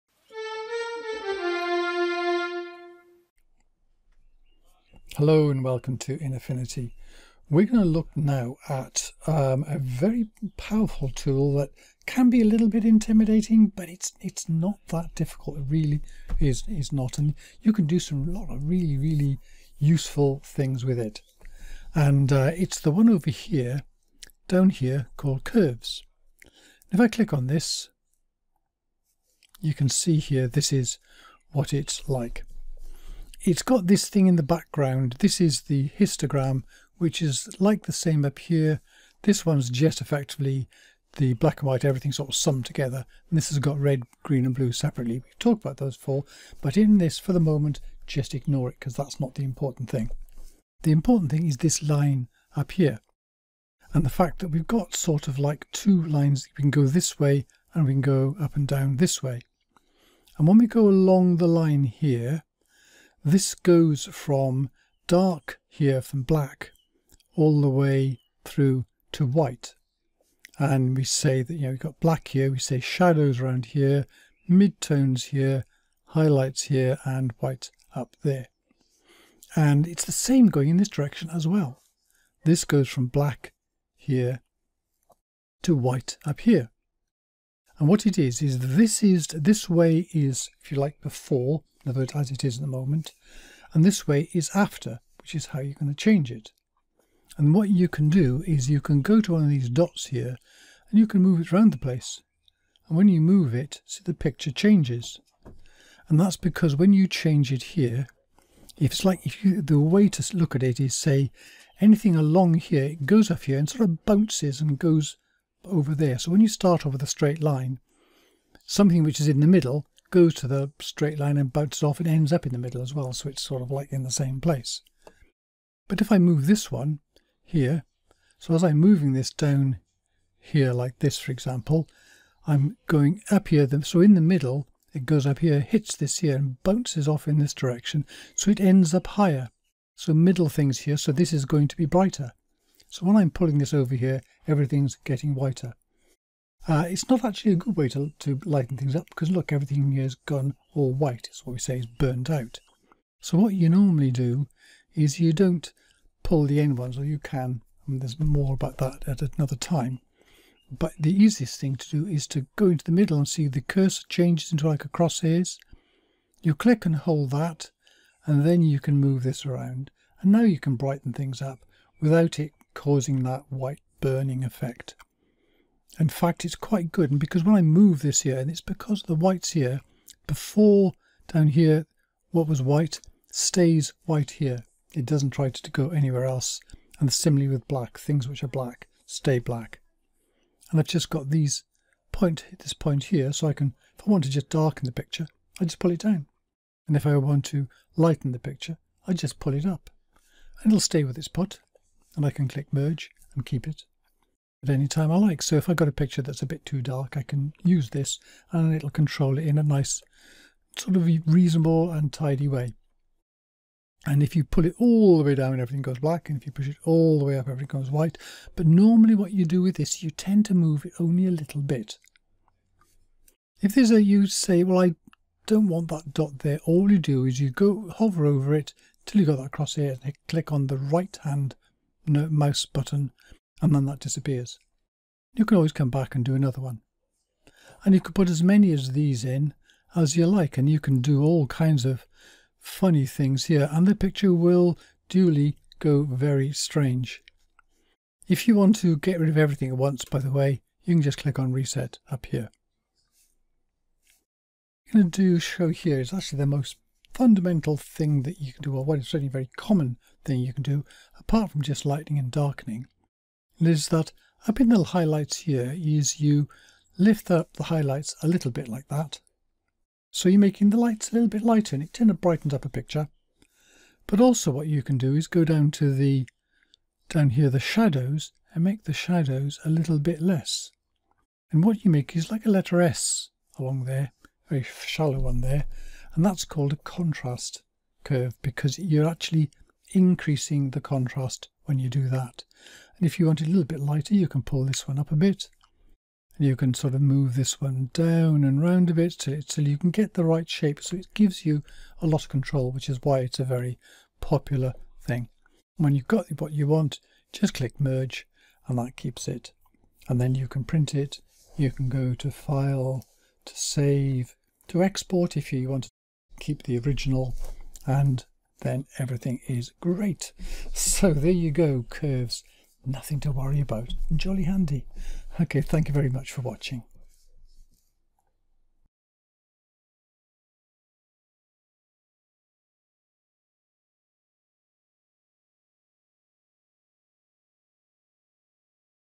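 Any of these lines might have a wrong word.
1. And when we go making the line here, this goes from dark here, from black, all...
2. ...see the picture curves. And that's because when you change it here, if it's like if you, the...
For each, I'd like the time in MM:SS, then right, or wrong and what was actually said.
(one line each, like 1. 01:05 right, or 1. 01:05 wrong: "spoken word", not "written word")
1. 01:00 wrong: "along", not "making"
2. 01:43 wrong: "changes", not "curves".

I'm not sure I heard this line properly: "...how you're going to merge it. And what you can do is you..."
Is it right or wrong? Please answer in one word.
wrong.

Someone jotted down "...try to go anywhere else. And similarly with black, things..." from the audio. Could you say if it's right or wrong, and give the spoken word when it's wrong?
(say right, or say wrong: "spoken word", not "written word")
right.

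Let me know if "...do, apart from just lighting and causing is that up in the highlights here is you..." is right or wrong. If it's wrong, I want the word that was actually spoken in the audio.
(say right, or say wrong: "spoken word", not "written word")
wrong: "darkening", not "causing".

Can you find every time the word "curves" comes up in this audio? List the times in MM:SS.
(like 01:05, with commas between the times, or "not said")
00:25, 04:48, 05:21.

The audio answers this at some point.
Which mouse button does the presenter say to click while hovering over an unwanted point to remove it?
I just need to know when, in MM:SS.
03:50.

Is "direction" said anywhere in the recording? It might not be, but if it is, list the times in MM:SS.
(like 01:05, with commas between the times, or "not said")
01:20, 02:17.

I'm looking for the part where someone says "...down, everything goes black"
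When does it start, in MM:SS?
03:35.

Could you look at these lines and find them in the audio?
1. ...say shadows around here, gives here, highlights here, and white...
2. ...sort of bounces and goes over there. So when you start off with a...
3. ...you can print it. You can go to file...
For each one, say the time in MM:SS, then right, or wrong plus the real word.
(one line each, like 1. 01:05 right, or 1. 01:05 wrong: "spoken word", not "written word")
1. 01:12 wrong: "midtones", not "gives"
2. 01:53 right
3. 05:10 right.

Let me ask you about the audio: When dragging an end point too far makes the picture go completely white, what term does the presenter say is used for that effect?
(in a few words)
Burnt out.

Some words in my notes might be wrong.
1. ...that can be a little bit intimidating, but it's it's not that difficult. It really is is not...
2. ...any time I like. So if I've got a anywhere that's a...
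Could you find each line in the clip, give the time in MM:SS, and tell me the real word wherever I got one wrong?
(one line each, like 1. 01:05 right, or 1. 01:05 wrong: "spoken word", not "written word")
1. 00:11 right
2. 03:24 wrong: "picture", not "anywhere".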